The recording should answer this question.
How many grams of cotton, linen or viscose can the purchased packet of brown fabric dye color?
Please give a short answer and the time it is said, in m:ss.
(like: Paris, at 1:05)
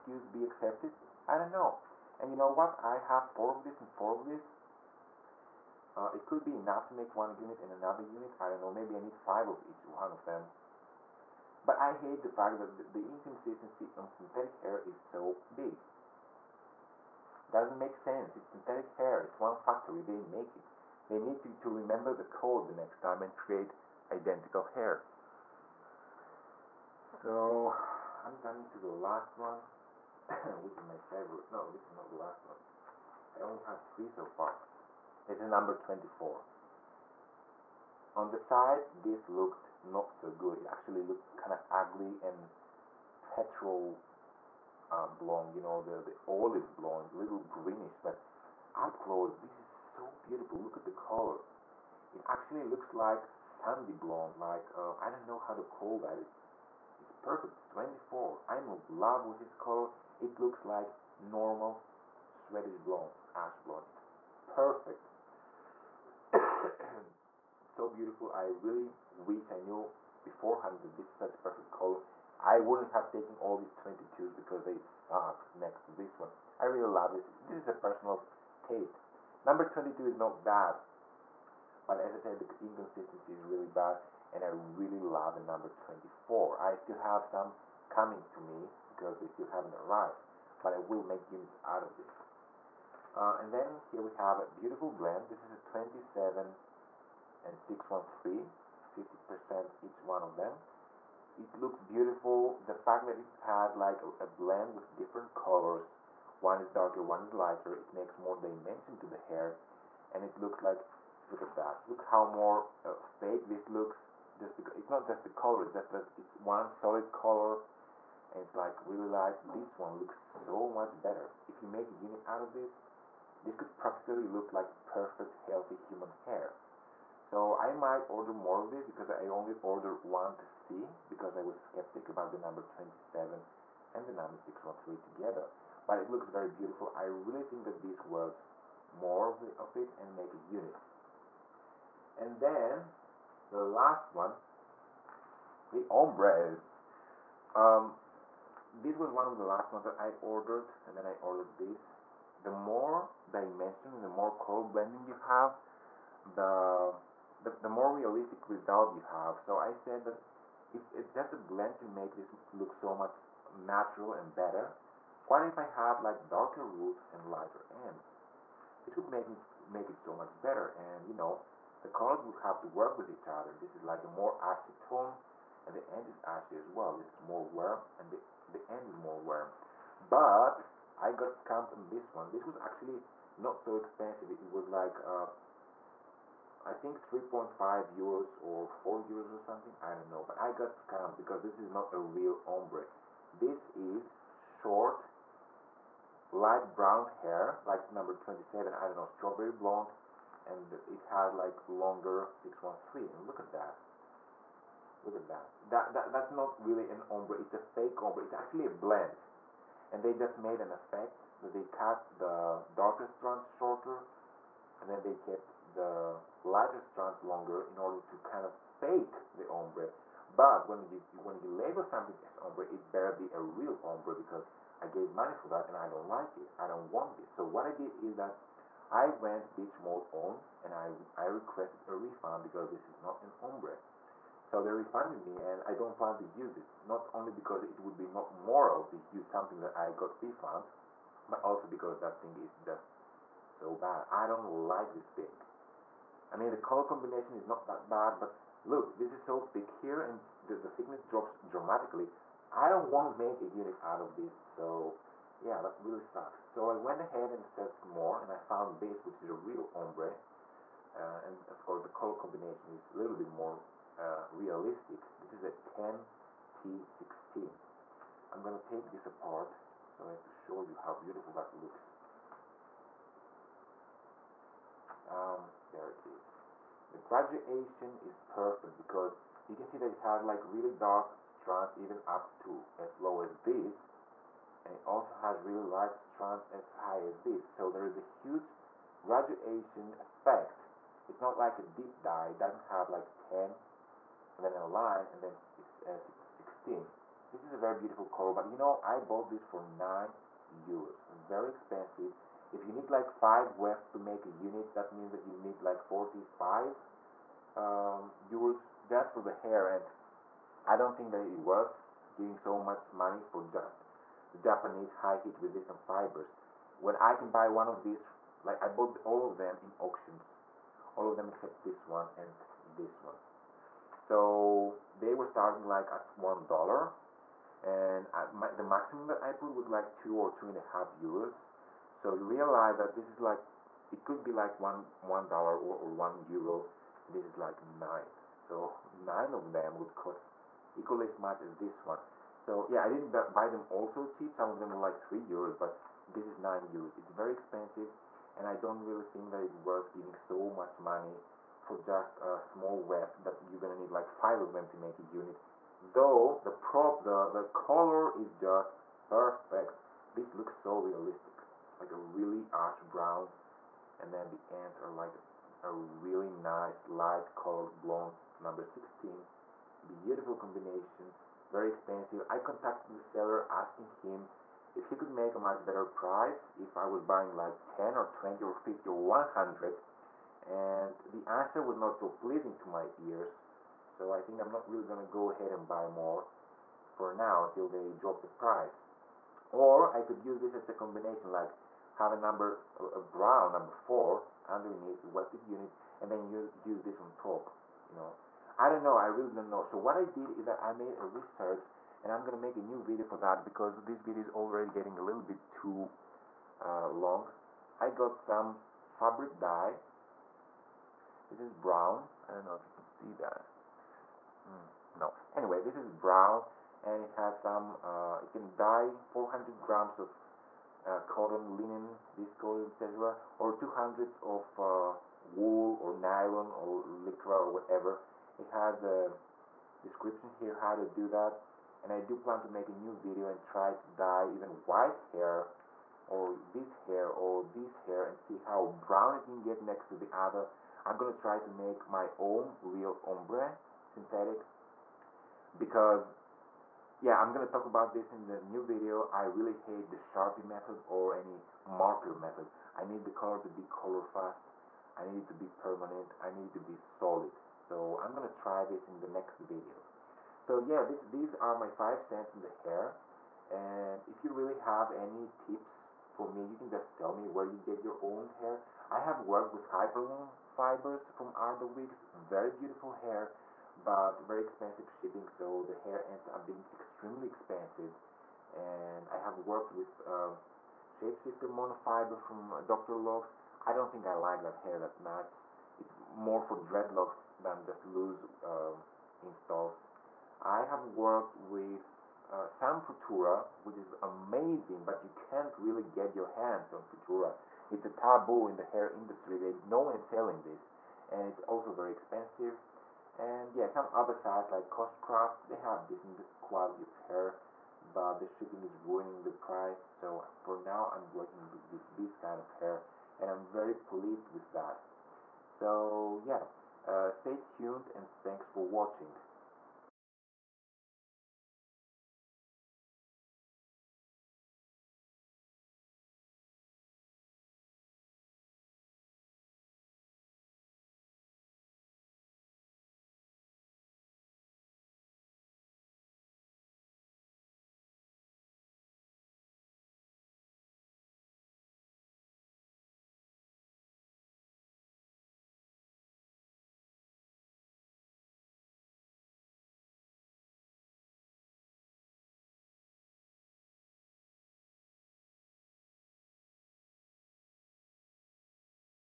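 400 grams, at 6:59.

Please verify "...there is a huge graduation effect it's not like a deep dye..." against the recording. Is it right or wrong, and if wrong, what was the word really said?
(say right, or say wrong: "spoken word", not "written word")
right.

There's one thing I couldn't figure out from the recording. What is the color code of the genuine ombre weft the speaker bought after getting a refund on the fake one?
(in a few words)
10T16.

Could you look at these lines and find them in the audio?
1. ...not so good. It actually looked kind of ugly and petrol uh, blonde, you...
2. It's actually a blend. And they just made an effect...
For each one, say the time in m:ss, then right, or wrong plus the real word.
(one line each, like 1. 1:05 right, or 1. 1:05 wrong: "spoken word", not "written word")
1. 0:39 right
2. 3:28 right.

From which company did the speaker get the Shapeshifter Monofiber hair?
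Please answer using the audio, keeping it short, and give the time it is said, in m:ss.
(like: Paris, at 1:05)
Doctored Locks, at 8:02.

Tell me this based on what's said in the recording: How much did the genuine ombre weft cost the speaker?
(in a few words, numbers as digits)
9 euros.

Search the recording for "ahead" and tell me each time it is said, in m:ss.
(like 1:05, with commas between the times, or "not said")
4:16, 6:25.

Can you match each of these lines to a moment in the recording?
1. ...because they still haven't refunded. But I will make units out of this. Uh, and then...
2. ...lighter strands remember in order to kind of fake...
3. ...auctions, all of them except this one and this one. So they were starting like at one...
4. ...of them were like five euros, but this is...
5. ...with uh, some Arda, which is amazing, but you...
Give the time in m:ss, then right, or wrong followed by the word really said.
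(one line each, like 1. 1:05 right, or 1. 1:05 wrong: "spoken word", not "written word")
1. 1:28 wrong: "arrived", not "refunded"
2. 3:36 wrong: "longer", not "remember"
3. 5:19 right
4. 5:44 wrong: "three", not "five"
5. 8:11 wrong: "Futura", not "Arda".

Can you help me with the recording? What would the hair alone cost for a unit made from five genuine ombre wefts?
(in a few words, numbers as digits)
45 euros.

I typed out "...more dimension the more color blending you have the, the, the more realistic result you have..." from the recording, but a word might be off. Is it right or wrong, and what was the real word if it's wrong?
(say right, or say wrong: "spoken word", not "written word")
right.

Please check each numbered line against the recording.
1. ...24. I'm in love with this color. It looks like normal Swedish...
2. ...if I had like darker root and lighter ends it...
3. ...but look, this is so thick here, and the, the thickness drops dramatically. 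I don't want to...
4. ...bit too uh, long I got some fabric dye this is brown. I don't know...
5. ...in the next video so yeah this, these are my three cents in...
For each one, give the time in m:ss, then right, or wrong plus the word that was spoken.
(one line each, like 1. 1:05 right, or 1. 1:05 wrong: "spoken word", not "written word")
1. 0:57 right
2. 2:45 right
3. 4:08 right
4. 6:45 right
5. 7:38 wrong: "five", not "three".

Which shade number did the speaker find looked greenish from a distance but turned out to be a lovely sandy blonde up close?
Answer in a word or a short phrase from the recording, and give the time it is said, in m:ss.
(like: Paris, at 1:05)
24, at 0:35.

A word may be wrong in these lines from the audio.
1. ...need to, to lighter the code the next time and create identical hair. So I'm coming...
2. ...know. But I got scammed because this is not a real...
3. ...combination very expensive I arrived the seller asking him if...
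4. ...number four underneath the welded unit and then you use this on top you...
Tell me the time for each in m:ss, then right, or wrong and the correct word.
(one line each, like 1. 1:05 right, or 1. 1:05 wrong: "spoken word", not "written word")
1. 0:21 wrong: "remember", not "lighter"
2. 3:10 right
3. 6:10 wrong: "contacted", not "arrived"
4. 6:33 right.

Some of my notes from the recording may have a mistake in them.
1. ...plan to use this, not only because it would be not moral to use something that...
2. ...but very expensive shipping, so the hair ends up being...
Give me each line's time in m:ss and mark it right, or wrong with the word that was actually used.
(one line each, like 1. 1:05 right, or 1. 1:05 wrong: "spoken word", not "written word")
1. 3:55 right
2. 7:53 right.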